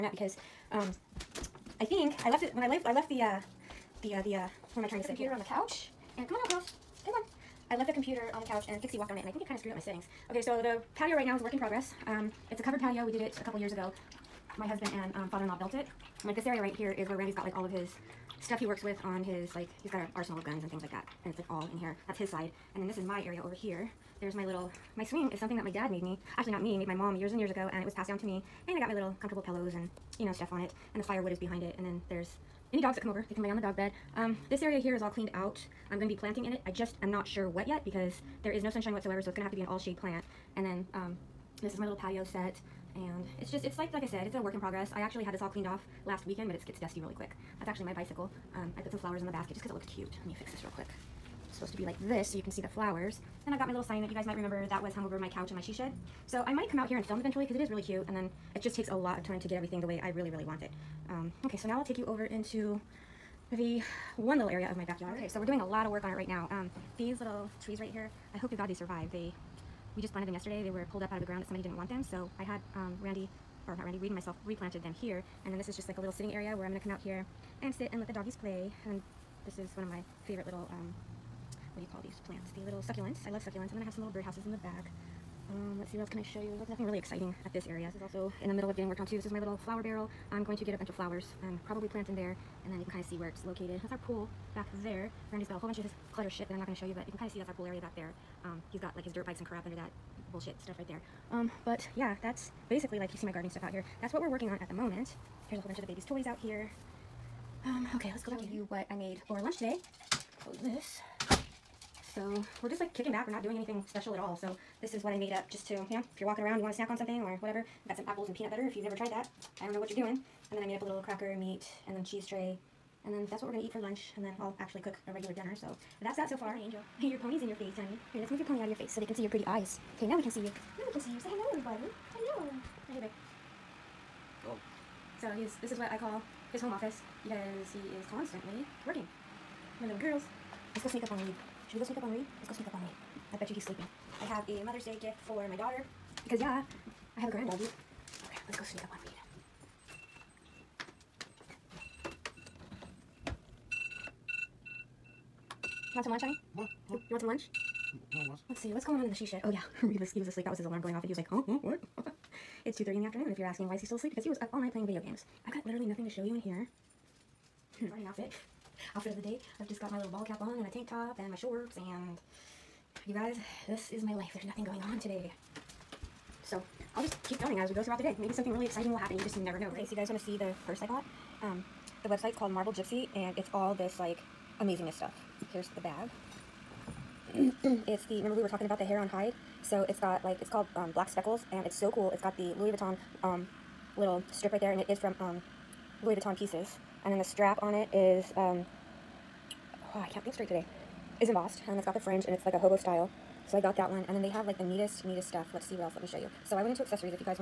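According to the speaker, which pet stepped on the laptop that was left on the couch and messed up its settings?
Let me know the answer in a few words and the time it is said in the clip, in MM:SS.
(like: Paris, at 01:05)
Pixie, at 00:08.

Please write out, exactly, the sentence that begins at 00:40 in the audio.
And then um, this is my little patio set.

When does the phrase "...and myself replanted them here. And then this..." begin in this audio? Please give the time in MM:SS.
01:14.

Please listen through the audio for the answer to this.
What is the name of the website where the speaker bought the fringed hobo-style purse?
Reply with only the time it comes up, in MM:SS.
03:02.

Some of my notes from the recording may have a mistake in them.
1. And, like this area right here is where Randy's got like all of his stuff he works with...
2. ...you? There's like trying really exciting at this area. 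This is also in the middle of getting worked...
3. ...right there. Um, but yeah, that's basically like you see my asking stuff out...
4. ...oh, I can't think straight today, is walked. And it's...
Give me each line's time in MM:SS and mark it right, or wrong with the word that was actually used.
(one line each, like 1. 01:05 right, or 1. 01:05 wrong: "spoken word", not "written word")
1. 00:16 right
2. 01:26 wrong: "nothing", not "trying"
3. 01:40 wrong: "gardening", not "asking"
4. 03:19 wrong: "embossed", not "walked".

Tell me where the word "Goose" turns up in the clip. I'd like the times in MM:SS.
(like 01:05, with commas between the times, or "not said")
not said.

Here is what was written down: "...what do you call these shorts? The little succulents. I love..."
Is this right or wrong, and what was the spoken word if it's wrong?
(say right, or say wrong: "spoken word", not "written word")
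wrong: "plants", not "shorts".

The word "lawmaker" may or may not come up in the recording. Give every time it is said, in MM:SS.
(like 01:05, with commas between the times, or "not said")
not said.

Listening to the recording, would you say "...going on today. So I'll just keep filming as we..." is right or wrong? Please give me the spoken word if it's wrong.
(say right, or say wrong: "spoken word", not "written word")
right.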